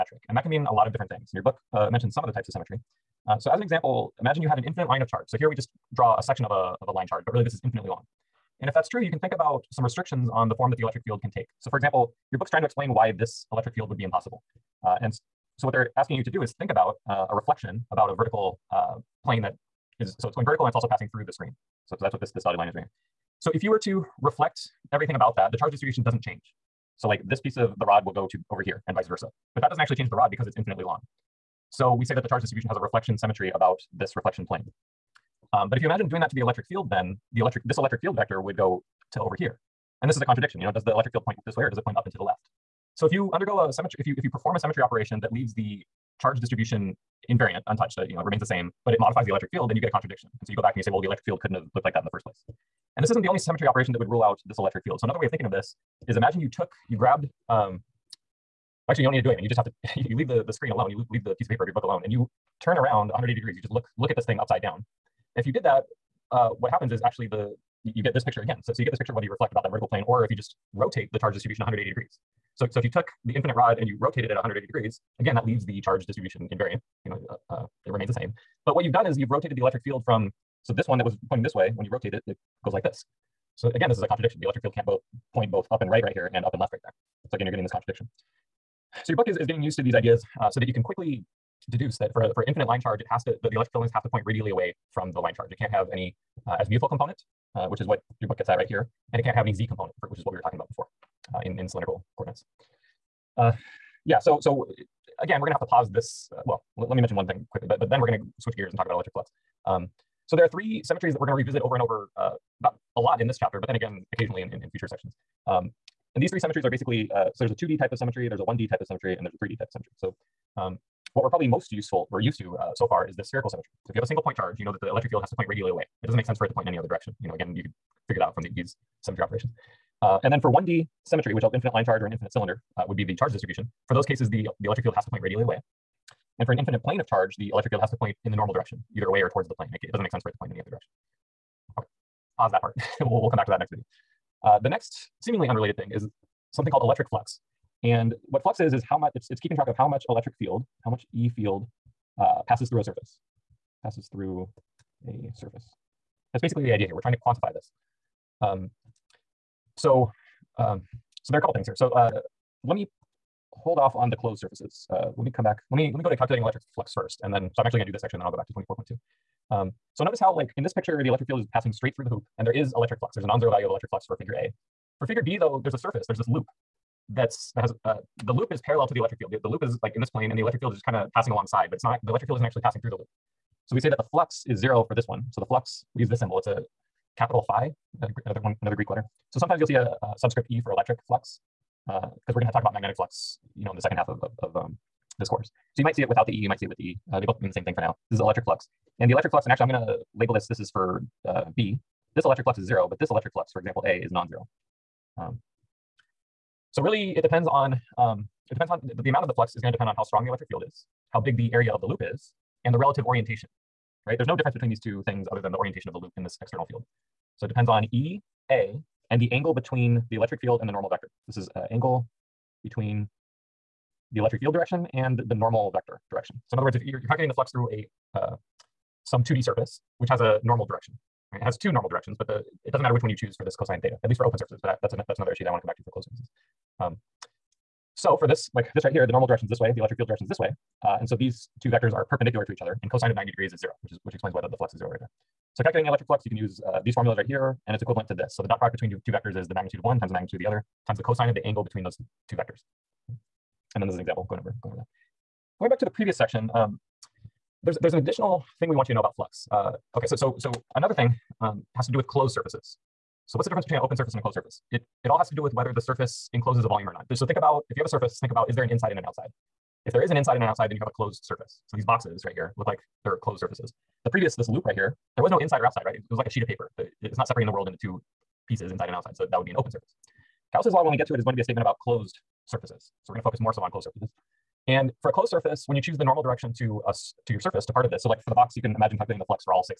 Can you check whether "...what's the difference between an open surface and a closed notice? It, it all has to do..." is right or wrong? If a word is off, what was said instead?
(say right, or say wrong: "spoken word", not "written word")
wrong: "surface", not "notice".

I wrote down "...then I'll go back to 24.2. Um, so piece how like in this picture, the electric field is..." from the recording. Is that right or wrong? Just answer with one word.
wrong.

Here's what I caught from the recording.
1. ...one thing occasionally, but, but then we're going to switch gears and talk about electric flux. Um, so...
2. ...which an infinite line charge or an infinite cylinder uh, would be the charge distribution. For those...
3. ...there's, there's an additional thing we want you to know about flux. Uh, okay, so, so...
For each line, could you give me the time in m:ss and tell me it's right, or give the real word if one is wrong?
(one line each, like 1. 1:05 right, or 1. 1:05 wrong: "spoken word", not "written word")
1. 1:47 wrong: "quickly", not "occasionally"
2. 2:11 right
3. 4:17 right.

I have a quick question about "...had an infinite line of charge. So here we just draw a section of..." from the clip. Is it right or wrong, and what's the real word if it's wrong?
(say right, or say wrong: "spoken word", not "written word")
right.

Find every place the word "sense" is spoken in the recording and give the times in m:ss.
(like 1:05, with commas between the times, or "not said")
2:06, 2:20.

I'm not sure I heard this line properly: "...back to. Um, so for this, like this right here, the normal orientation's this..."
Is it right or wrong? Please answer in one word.
wrong.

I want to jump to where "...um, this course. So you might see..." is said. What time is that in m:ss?
3:14.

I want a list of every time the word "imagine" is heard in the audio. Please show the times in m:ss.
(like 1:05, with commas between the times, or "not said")
0:04, 0:35, 0:56, 4:48.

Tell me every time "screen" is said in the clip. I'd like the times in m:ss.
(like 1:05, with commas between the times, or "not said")
0:21, 1:00.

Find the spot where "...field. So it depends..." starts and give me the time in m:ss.
3:36.